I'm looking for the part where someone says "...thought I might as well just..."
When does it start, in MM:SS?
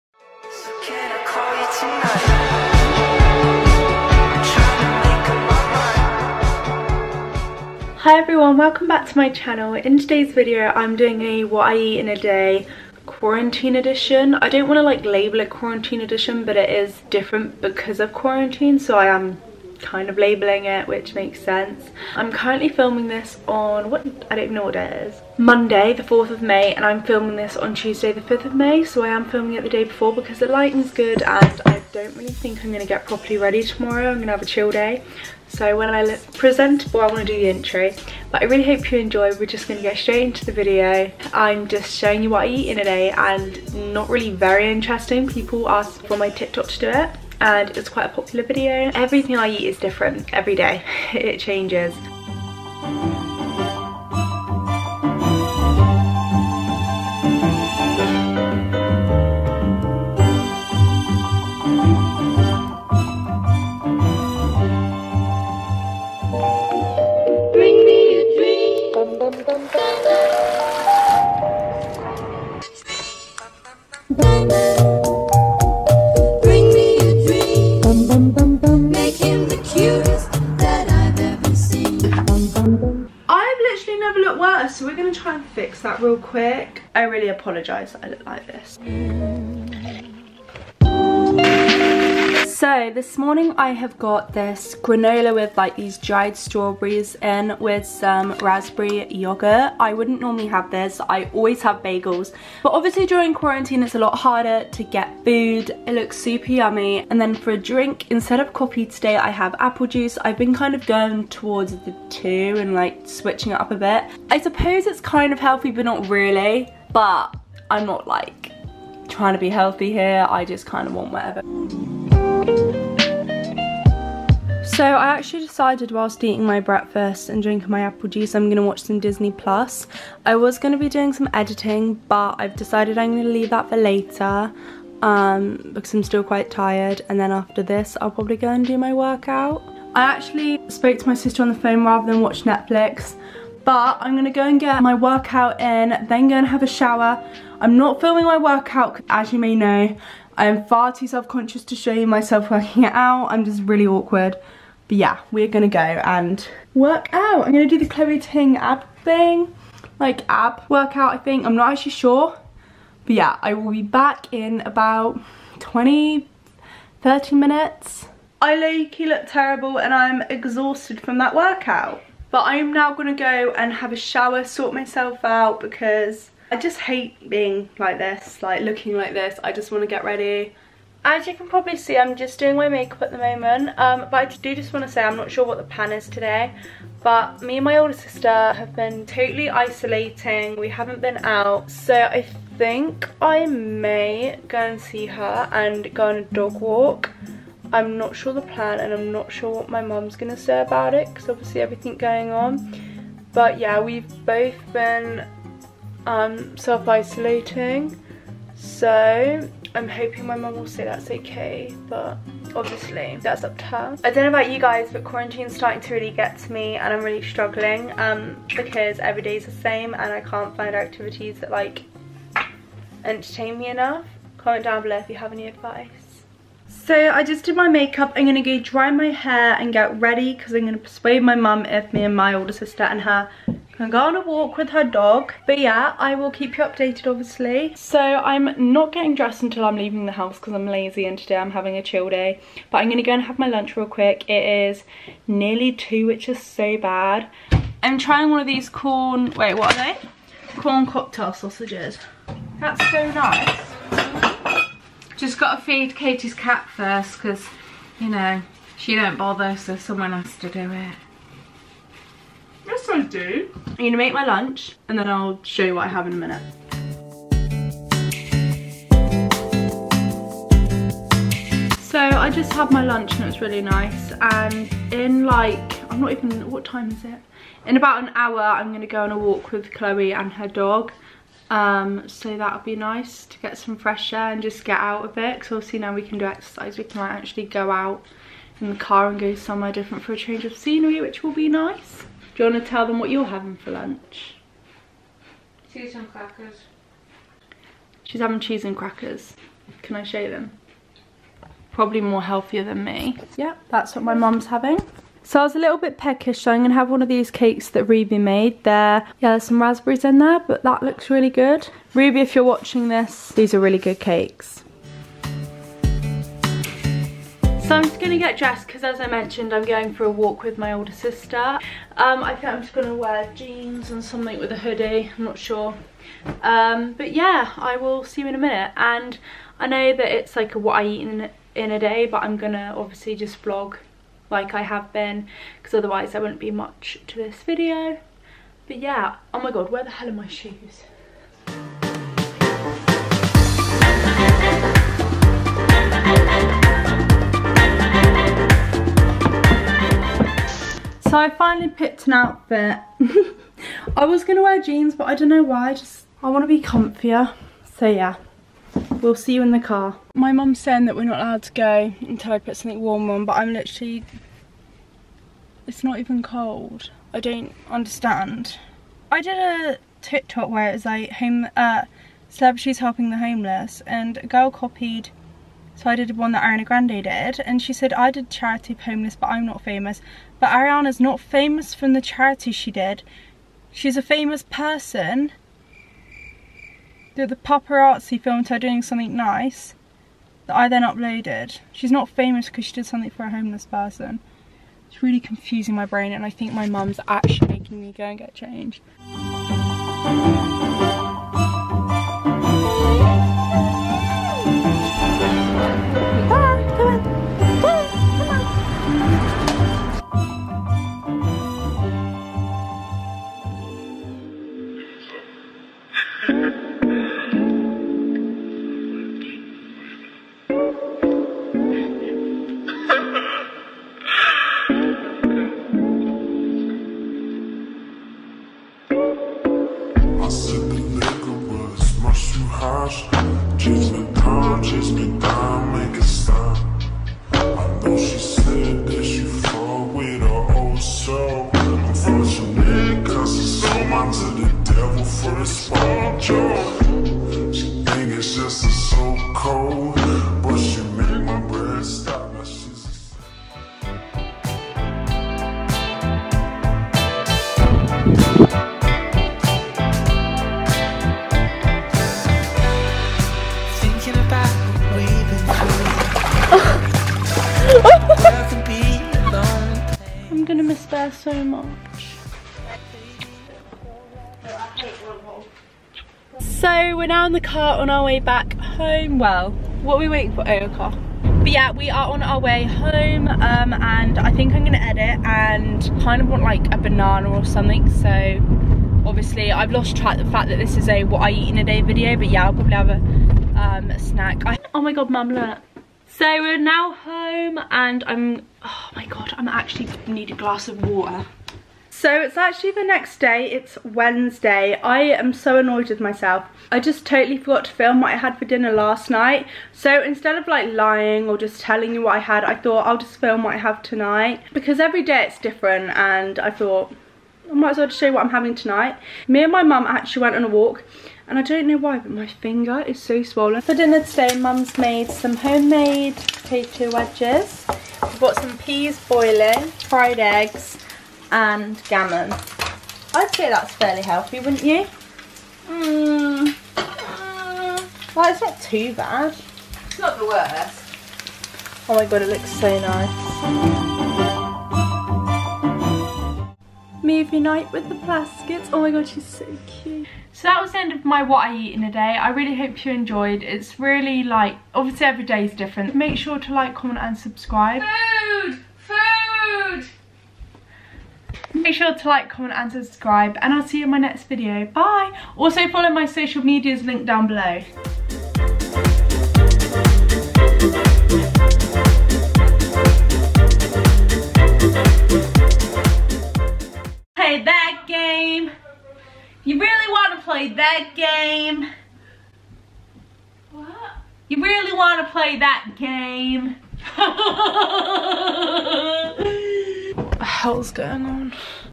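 08:36.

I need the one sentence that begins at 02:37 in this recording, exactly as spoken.
I'm gonna do the Chloe Ting ab thing, like ab workout I think.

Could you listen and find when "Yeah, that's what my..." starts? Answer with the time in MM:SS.
05:03.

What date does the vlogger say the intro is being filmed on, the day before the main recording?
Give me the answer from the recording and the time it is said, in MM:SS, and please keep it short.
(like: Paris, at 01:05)
Monday the 4th of May, at 00:25.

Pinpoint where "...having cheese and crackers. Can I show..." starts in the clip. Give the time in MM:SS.
04:58.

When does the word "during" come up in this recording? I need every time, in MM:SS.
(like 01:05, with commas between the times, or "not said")
01:43.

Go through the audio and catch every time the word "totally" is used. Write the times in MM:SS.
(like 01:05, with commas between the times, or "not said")
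03:09, 08:27.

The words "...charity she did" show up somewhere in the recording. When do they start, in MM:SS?
06:22.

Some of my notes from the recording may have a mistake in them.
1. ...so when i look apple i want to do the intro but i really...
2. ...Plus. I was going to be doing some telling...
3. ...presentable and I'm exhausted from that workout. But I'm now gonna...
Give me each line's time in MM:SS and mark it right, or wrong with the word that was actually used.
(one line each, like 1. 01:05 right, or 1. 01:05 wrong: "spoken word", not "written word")
1. 00:35 wrong: "presentable", not "apple"
2. 02:09 wrong: "editing", not "telling"
3. 02:49 wrong: "terrible", not "presentable".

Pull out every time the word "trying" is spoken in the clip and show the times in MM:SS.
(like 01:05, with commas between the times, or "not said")
01:59, 04:07.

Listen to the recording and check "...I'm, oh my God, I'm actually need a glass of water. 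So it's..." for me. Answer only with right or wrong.
right.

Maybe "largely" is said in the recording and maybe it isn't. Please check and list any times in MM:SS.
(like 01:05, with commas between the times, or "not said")
not said.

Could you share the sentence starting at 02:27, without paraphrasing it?
I'm not filming my workout, as you may know.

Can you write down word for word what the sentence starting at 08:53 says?
I'd say that's fairly healthy wouldn't you?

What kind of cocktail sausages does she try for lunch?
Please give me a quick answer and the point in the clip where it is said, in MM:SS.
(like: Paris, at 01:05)
Corn cocktail sausages, at 04:10.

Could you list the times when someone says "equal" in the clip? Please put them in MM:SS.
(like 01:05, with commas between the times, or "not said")
not said.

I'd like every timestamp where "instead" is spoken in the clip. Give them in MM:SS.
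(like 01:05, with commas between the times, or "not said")
01:48, 08:30.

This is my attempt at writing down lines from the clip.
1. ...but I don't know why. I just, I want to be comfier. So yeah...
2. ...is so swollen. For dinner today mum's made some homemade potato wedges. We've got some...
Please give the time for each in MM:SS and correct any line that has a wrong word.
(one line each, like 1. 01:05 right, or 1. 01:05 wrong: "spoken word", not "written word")
1. 05:54 right
2. 08:42 right.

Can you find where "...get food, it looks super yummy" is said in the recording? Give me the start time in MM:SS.
01:44.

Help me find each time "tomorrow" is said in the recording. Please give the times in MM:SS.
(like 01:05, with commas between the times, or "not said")
00:33.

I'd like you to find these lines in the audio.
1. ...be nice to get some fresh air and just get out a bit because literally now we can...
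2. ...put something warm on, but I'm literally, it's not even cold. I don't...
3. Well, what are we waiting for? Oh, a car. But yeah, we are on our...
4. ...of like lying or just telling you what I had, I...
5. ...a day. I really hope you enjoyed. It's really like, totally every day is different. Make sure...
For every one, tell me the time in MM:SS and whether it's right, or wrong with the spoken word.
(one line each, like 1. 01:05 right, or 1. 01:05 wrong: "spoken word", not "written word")
1. 04:42 wrong: "obviously", not "literally"
2. 06:02 right
3. 07:59 right
4. 08:30 right
5. 09:11 wrong: "obviously", not "totally".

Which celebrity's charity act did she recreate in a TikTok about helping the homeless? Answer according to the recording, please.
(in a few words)
Ariana Grande.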